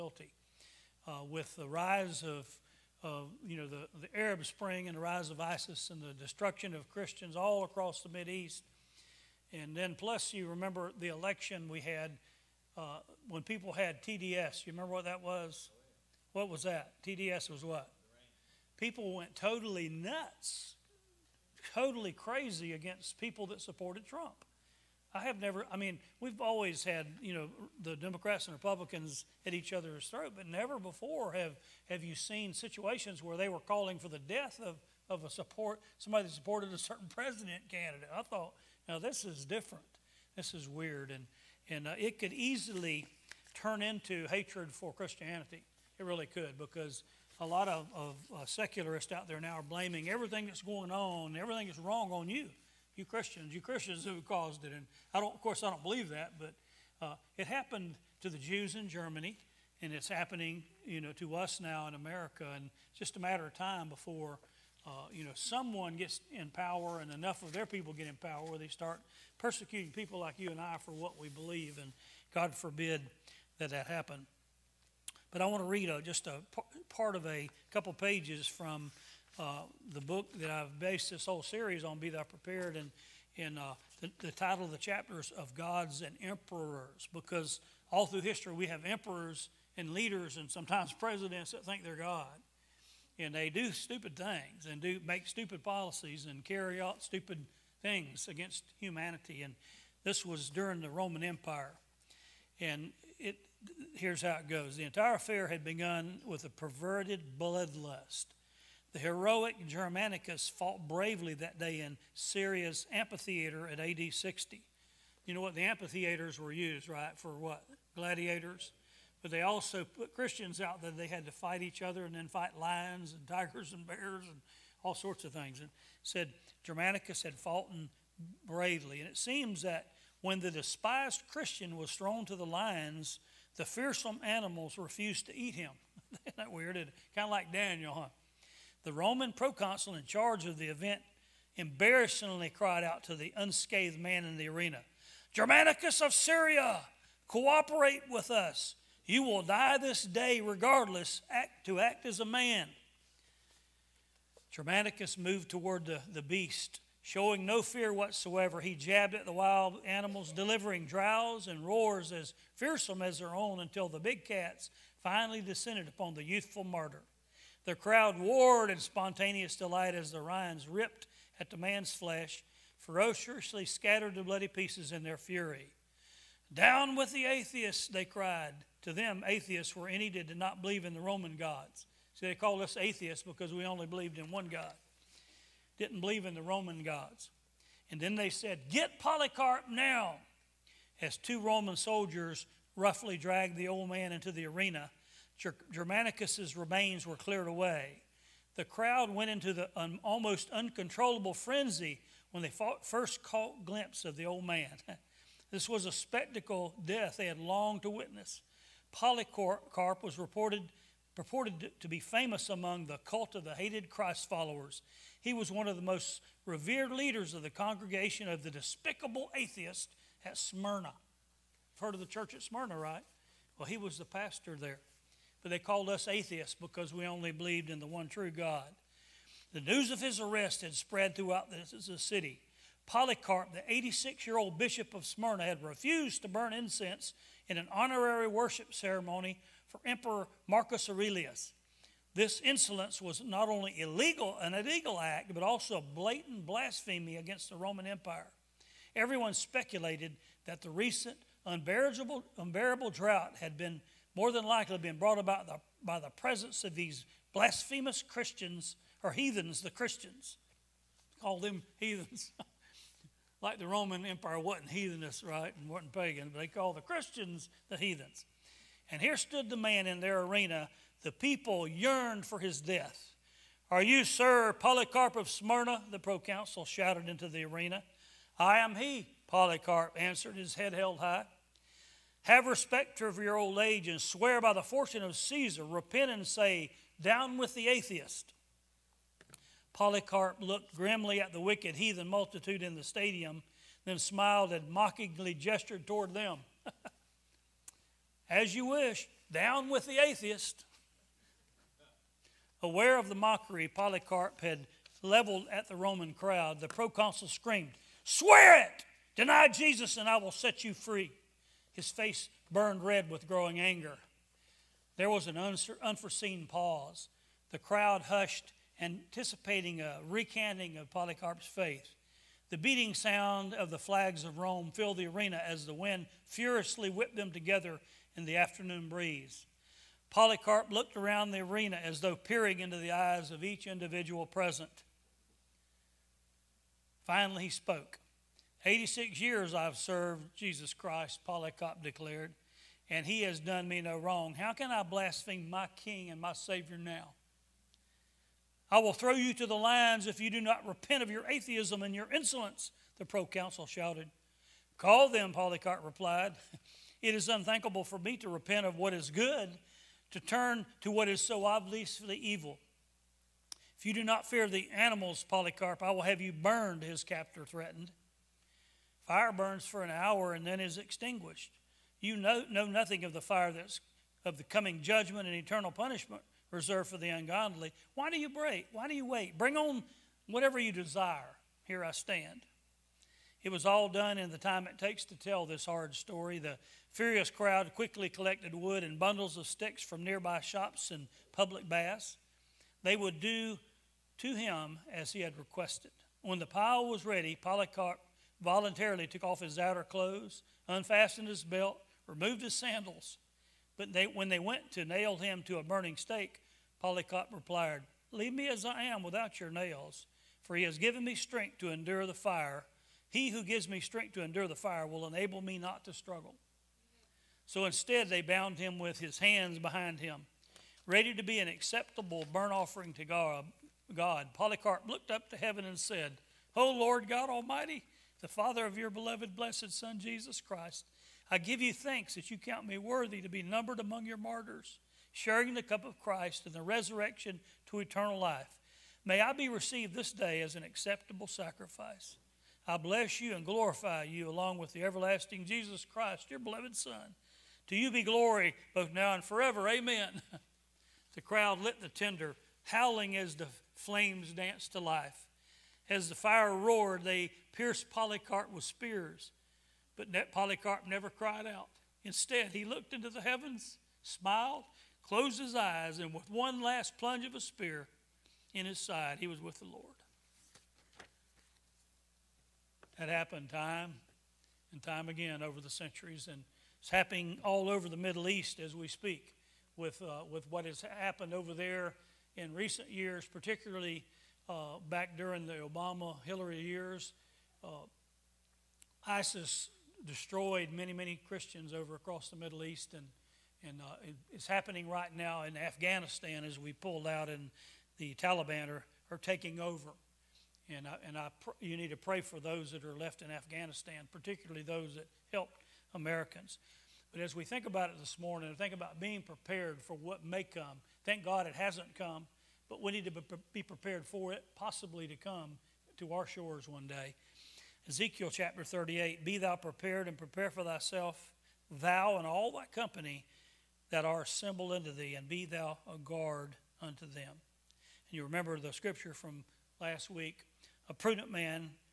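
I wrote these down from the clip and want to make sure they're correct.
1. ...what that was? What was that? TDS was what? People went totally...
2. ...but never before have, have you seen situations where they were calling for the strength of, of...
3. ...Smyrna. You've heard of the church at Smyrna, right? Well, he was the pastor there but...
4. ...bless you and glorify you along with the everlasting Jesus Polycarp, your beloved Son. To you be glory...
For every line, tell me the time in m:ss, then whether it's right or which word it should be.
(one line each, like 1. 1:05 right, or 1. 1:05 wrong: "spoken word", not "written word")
1. 0:14 right
2. 0:30 wrong: "death", not "strength"
3. 3:40 right
4. 7:22 wrong: "Christ", not "Polycarp".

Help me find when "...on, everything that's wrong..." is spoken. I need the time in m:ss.
0:50.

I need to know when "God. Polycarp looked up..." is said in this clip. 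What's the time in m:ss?
7:03.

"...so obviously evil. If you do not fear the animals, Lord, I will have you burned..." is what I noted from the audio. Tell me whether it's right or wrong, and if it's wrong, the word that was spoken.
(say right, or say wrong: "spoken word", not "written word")
wrong: "Polycarp", not "Lord".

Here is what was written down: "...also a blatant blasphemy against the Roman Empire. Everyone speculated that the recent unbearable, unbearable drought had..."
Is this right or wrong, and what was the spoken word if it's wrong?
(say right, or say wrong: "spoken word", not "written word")
right.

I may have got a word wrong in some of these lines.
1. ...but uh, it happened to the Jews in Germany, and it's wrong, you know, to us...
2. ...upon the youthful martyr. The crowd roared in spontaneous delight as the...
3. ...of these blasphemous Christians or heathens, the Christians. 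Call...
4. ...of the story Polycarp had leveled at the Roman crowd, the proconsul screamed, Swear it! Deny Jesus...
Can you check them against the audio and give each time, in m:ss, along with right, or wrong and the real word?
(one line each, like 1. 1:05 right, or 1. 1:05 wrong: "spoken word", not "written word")
1. 0:56 wrong: "happening", not "wrong"
2. 2:45 right
3. 4:16 right
4. 5:02 wrong: "mockery", not "story".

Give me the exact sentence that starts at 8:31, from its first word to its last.
Thank God it hasn't come but we need to be prepared for it possibly to come to our shores one day.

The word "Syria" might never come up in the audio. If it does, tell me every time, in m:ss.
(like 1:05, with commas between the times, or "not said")
1:52, 2:26.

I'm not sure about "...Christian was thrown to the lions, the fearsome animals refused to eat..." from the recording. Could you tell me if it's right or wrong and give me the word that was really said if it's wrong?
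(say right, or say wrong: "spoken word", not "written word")
right.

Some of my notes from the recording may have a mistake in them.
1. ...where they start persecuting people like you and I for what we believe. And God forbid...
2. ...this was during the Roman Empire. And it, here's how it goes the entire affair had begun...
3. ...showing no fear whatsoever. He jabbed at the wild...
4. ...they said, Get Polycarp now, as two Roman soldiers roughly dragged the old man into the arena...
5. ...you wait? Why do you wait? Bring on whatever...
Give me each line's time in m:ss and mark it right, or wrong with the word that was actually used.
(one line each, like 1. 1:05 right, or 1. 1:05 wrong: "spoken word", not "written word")
1. 1:08 right
2. 1:40 right
3. 2:37 right
4. 3:08 right
5. 6:18 right.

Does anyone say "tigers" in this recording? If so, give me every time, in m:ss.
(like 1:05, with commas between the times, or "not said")
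2:03.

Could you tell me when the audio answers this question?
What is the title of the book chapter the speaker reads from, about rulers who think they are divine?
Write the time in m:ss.
1:25.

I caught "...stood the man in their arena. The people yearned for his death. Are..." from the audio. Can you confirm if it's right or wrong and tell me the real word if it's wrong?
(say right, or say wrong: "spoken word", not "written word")
right.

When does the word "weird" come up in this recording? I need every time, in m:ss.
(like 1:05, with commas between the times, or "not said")
0:40, 2:16.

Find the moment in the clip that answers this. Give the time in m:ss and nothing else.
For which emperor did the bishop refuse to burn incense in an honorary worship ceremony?
4:00.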